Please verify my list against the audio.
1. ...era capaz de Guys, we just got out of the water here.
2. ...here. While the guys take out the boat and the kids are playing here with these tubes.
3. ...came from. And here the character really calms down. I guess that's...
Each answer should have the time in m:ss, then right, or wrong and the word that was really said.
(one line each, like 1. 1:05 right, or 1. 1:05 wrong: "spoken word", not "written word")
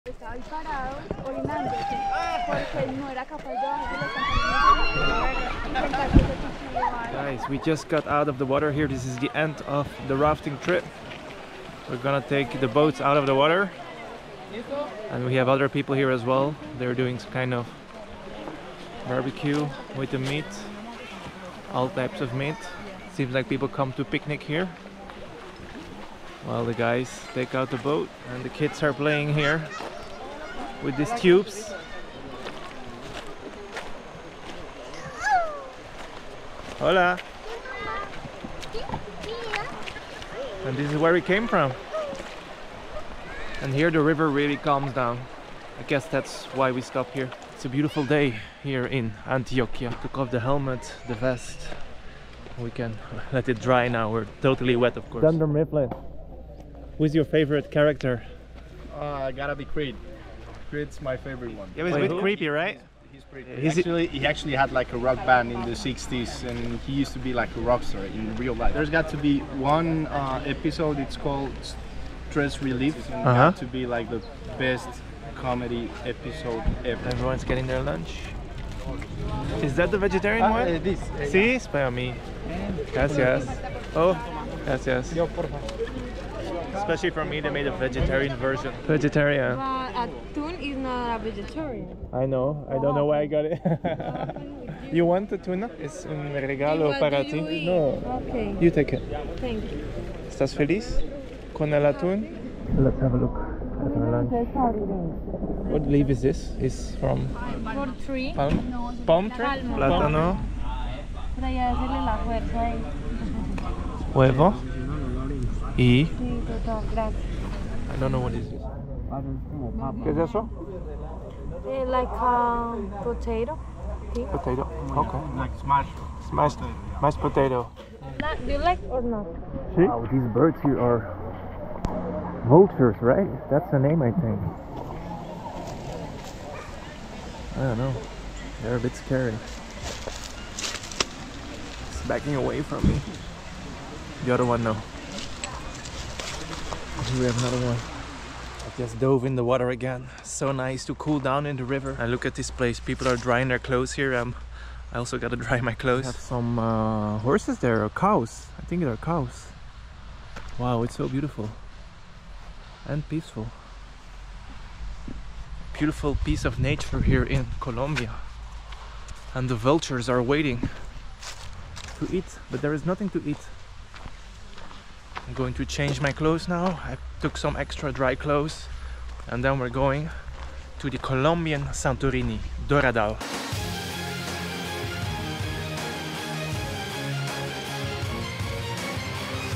1. 0:03 right
2. 0:24 right
3. 0:41 wrong: "river", not "character".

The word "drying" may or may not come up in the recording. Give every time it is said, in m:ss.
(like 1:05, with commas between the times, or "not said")
2:33.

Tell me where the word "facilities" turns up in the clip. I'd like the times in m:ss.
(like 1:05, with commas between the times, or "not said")
not said.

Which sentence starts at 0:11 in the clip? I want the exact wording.
We're gonna take the boats out of the water.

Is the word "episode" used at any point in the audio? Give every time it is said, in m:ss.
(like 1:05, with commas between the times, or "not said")
1:10, 1:16.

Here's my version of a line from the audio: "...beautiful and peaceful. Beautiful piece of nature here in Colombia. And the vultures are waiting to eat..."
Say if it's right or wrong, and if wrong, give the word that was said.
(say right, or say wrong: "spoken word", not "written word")
right.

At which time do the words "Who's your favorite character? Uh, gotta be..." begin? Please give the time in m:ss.
0:56.